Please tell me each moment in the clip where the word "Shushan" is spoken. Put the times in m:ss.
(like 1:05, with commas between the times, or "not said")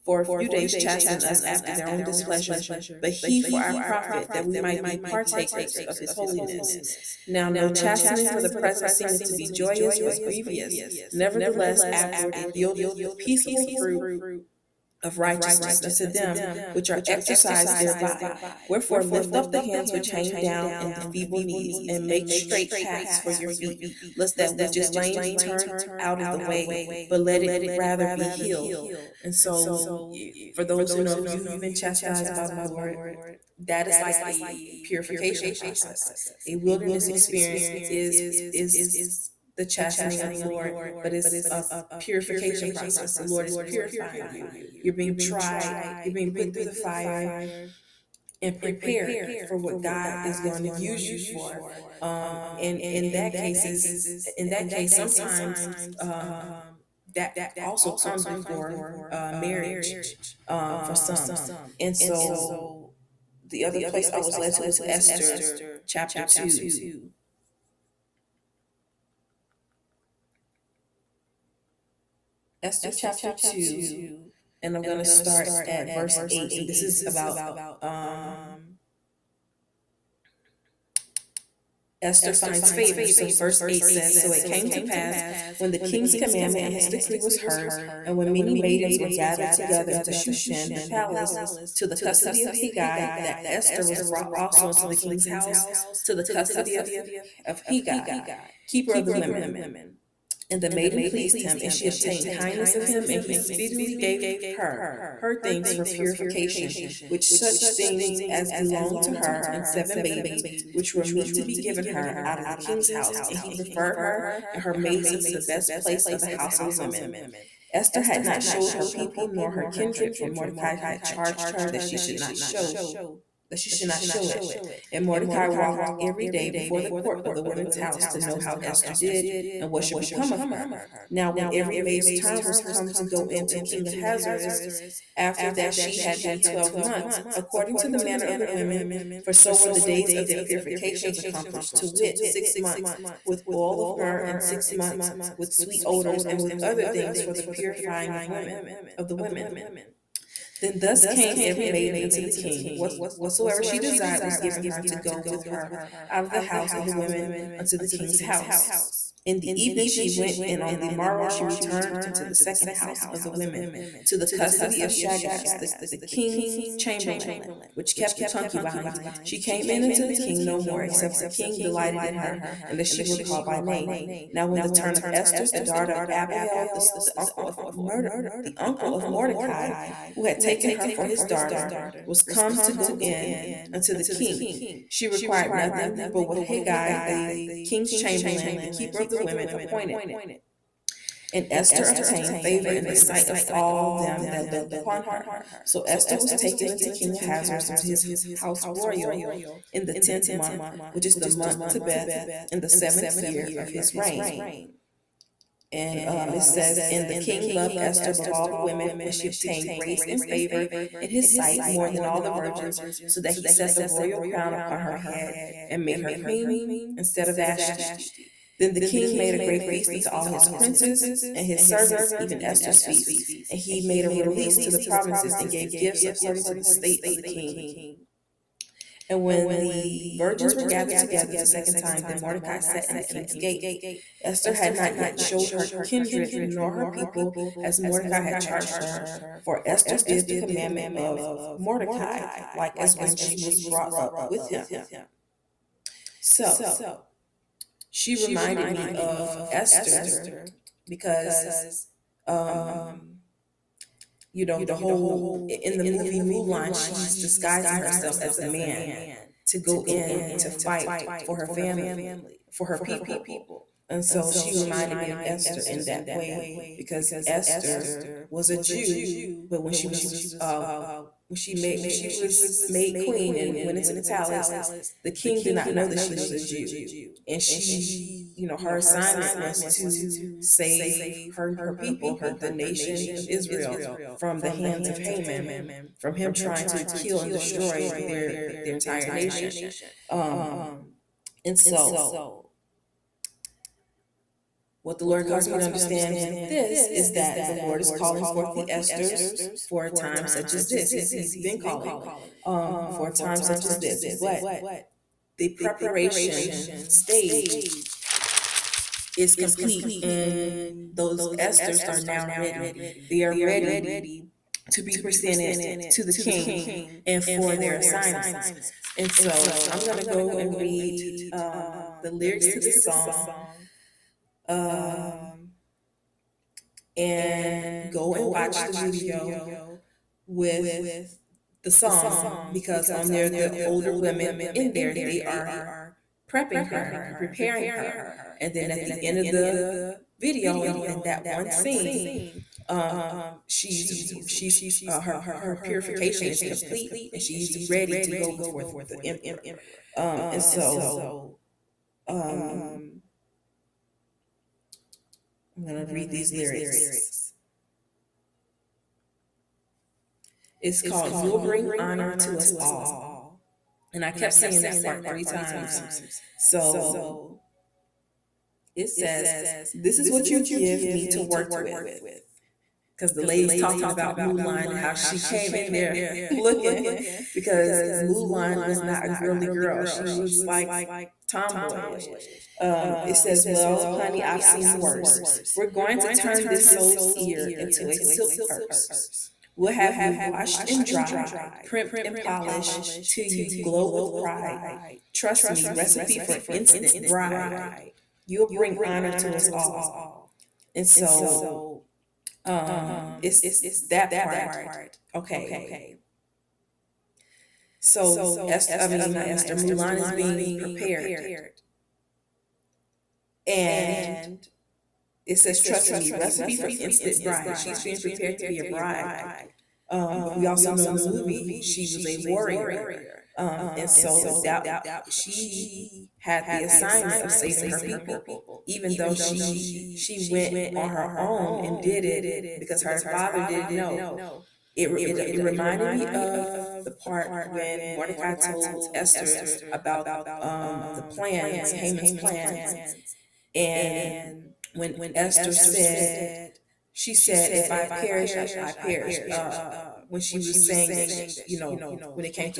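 1:30.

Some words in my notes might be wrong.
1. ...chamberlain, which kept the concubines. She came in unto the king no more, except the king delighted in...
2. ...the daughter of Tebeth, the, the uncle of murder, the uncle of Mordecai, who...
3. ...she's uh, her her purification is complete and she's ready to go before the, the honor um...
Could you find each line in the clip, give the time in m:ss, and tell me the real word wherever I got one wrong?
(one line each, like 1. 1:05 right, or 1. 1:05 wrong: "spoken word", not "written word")
1. 2:46 right
2. 2:55 wrong: "Abihail", not "Tebeth"
3. 5:44 wrong: "emperor", not "honor".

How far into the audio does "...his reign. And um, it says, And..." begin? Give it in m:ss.
3:23.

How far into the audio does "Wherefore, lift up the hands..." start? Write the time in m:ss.
0:18.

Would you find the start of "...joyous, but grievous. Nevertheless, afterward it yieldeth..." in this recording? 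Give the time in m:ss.
0:09.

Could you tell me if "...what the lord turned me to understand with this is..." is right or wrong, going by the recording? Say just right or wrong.
wrong.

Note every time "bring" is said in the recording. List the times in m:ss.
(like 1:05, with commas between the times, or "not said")
6:01, 6:38.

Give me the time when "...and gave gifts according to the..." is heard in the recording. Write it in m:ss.
3:45.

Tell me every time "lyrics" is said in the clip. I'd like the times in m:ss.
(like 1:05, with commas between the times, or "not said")
5:22, 5:56.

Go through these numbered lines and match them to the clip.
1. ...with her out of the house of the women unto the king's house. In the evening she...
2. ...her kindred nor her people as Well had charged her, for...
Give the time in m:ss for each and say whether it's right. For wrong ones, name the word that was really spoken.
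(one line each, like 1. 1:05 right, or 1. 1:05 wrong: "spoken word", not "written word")
1. 2:35 right
2. 3:55 wrong: "Mordecai", not "Well".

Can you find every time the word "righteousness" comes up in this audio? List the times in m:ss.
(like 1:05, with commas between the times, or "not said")
0:15.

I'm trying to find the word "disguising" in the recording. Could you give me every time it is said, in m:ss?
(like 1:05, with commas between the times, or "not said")
4:17.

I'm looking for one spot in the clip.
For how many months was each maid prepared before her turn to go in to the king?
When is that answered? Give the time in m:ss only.
2:16.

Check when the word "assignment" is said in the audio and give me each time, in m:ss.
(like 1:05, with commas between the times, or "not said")
4:38, 5:17, 7:06.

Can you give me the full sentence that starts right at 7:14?
It, it, it reminded me of the part when Mordecai told Esther about um, the plans, Haman's plans.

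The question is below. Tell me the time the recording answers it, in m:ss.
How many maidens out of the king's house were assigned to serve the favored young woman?
1:49.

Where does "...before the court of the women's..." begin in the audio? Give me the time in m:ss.
2:06.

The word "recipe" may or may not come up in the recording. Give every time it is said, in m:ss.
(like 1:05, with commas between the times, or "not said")
6:35, 6:56.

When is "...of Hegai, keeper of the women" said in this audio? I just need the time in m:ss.
1:37.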